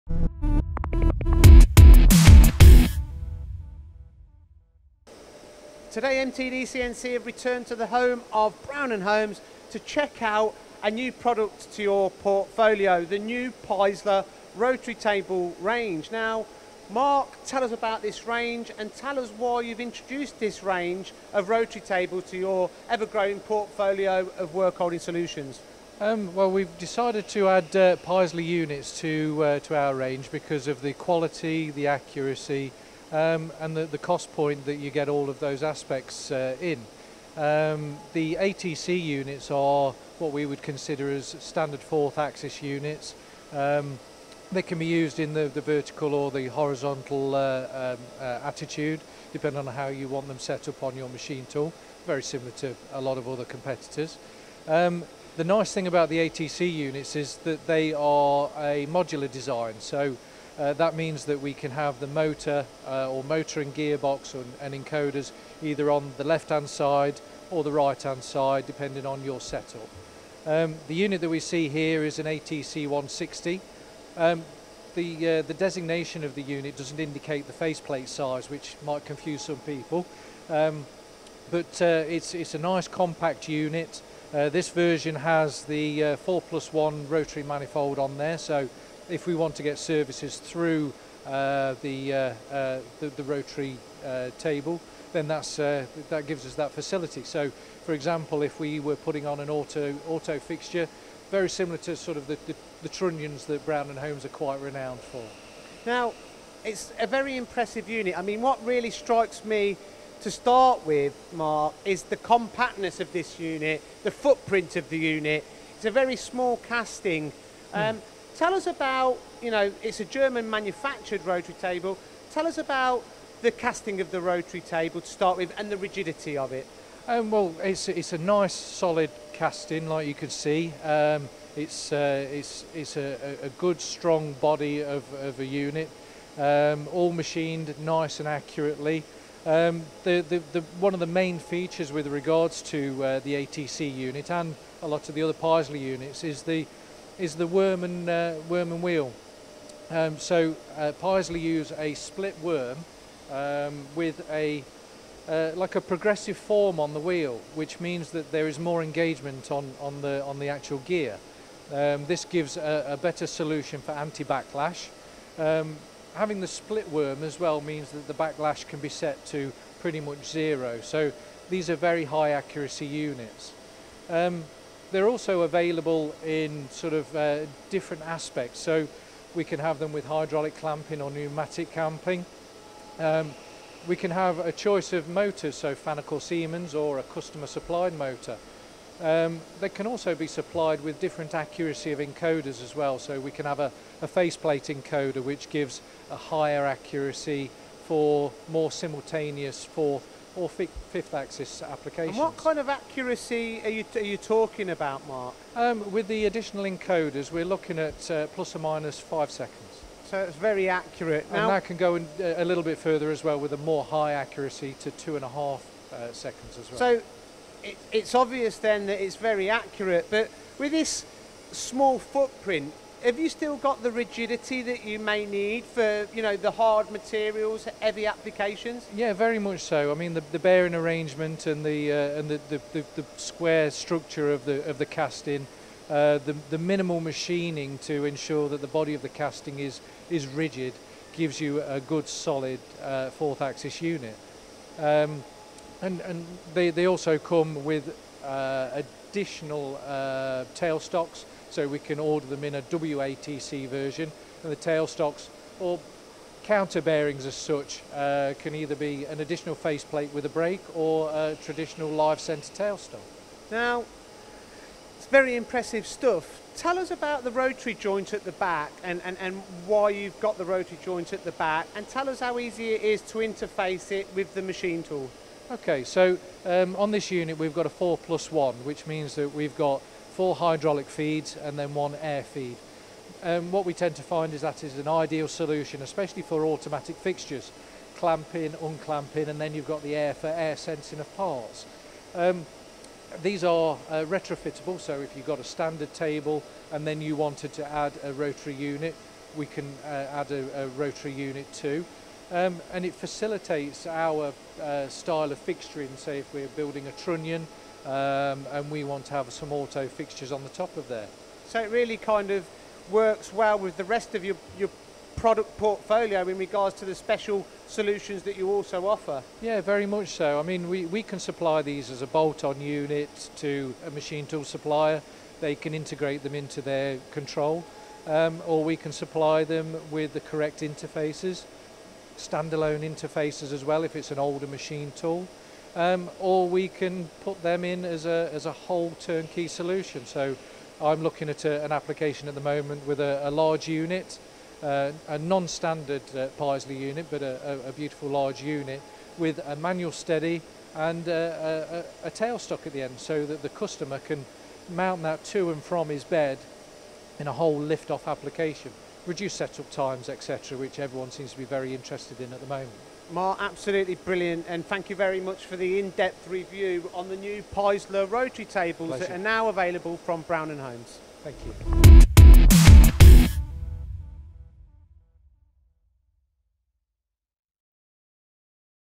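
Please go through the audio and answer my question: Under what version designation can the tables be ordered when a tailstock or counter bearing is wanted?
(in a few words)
WATC.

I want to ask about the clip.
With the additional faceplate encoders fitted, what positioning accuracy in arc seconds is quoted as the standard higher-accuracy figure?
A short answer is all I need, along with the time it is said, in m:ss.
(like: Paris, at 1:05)
plus or minus 5 seconds, at 3:28.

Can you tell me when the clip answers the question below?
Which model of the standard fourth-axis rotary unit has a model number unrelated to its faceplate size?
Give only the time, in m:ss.
1:12.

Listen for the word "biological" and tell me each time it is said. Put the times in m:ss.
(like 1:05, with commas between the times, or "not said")
not said.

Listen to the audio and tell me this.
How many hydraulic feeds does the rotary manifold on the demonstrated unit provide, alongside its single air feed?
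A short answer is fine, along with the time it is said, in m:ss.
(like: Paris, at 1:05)
4, at 4:40.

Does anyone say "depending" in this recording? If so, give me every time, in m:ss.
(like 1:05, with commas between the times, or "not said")
0:49, 1:08.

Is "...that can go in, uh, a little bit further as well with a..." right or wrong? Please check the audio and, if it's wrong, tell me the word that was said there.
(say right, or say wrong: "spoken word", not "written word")
right.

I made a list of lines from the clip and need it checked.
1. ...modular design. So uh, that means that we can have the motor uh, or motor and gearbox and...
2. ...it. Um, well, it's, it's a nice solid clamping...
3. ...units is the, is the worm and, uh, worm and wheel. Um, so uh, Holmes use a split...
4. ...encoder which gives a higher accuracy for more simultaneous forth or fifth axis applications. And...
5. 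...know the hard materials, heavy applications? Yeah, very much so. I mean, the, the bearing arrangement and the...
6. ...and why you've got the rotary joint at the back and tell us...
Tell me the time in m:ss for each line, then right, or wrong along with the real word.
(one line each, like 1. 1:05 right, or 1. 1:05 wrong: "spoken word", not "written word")
1. 0:58 right
2. 2:06 wrong: "casting", not "clamping"
3. 2:25 wrong: "Peiseler", not "Holmes"
4. 3:14 right
5. 3:46 right
6. 4:29 right.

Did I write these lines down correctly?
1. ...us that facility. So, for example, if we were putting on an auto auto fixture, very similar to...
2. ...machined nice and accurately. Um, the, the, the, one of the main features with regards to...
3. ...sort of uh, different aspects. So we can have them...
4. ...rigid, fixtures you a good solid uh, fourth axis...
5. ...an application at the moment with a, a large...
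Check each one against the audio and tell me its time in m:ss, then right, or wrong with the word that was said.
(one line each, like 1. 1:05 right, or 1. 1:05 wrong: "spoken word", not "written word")
1. 1:36 right
2. 2:17 right
3. 2:56 right
4. 4:00 wrong: "gives", not "fixtures"
5. 5:41 right.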